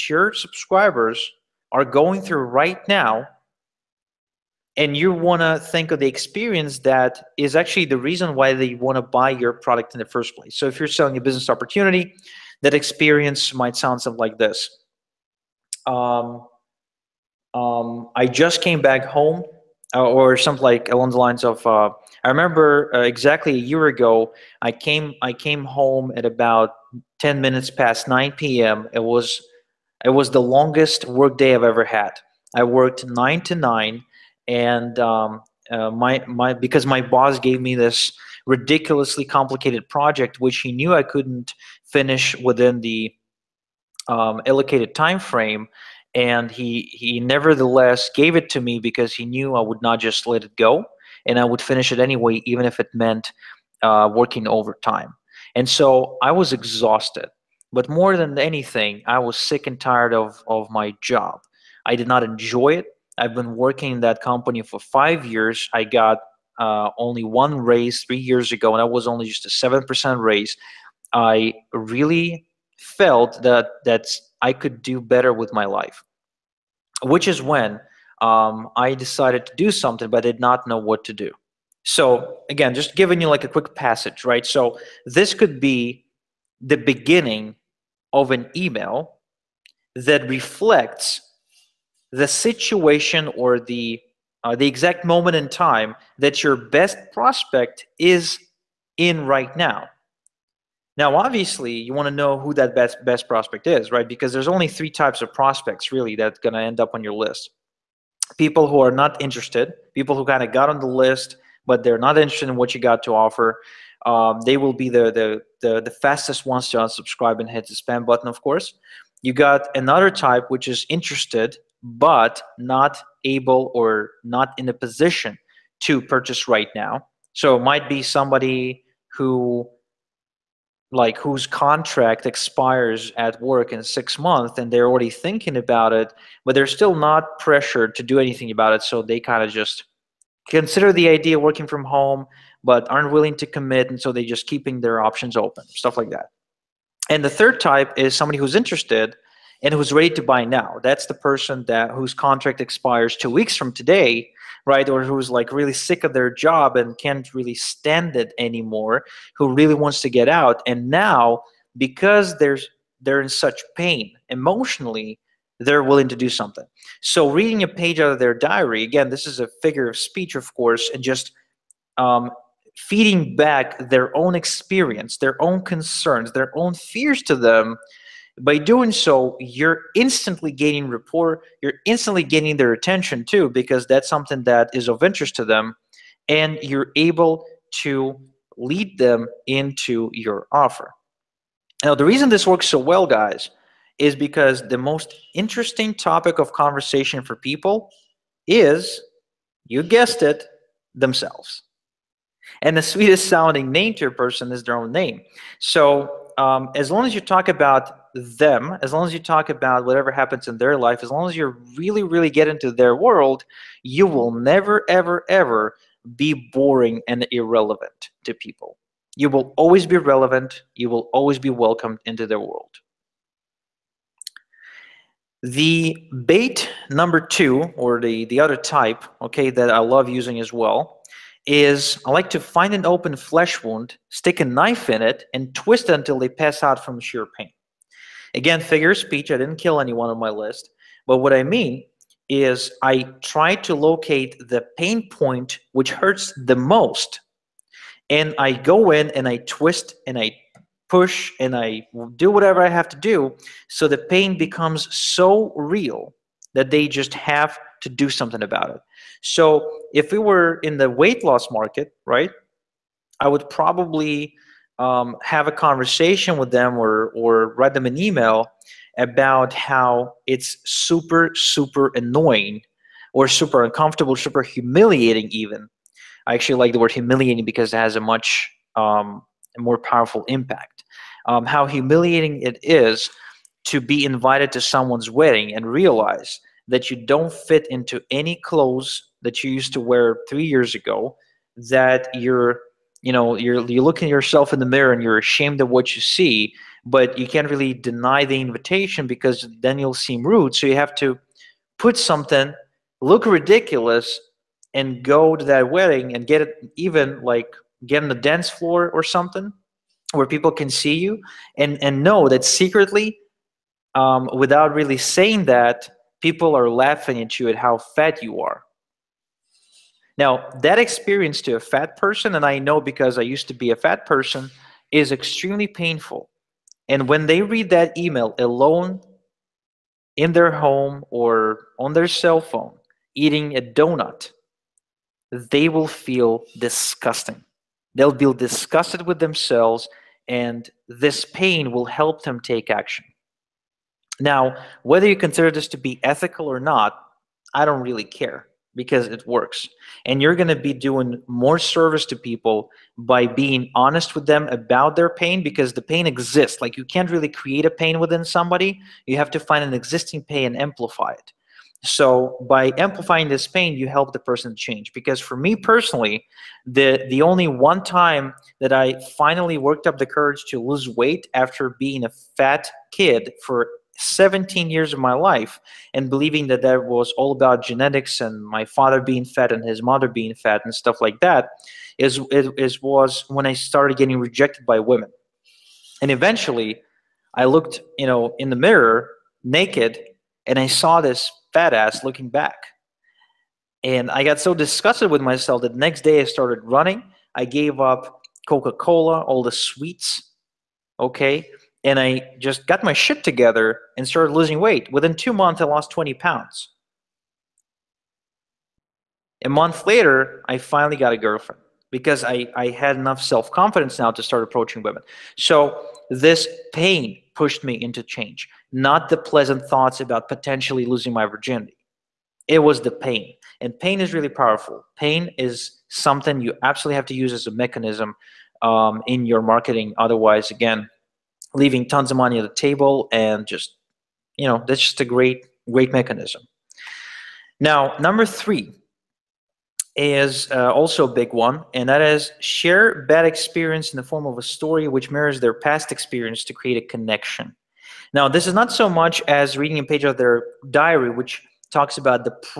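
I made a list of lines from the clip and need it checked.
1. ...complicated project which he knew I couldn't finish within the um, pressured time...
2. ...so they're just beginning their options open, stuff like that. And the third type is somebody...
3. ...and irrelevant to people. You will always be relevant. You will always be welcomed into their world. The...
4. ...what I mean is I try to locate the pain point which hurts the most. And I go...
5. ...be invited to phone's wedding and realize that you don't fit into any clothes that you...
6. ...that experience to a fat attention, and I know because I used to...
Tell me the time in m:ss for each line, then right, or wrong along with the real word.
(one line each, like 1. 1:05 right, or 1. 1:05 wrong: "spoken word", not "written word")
1. 0:39 wrong: "allocated", not "pressured"
2. 2:23 wrong: "keeping", not "beginning"
3. 3:37 right
4. 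4:01 right
5. 4:43 wrong: "someone", not "phone"
6. 5:20 wrong: "person", not "attention".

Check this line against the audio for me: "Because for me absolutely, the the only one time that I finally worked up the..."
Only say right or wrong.
wrong.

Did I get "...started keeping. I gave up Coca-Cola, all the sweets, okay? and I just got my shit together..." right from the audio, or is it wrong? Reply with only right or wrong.
wrong.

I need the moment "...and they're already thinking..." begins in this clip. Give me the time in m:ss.
2:14.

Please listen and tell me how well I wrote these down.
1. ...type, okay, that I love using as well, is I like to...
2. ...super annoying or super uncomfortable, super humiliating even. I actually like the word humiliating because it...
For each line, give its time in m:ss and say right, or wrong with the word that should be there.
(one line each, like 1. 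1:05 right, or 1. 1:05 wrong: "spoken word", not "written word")
1. 3:48 right
2. 4:31 right.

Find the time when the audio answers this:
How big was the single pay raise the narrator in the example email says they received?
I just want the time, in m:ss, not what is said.
1:09.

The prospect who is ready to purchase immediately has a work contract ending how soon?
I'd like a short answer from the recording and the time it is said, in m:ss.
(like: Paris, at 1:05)
2 weeks, at 2:33.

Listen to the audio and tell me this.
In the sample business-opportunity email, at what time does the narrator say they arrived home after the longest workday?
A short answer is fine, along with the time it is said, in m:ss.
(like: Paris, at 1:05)
9:10 PM, at 0:27.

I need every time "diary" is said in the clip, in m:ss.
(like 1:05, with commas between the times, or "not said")
2:48, 7:30.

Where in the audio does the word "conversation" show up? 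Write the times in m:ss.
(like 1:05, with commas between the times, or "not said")
3:16, 4:25.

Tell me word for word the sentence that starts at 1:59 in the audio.
You got another type which is interested but not able or not in a position to purchase right now.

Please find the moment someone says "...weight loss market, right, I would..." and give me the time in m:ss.
4:20.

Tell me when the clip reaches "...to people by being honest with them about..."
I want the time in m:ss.
5:52.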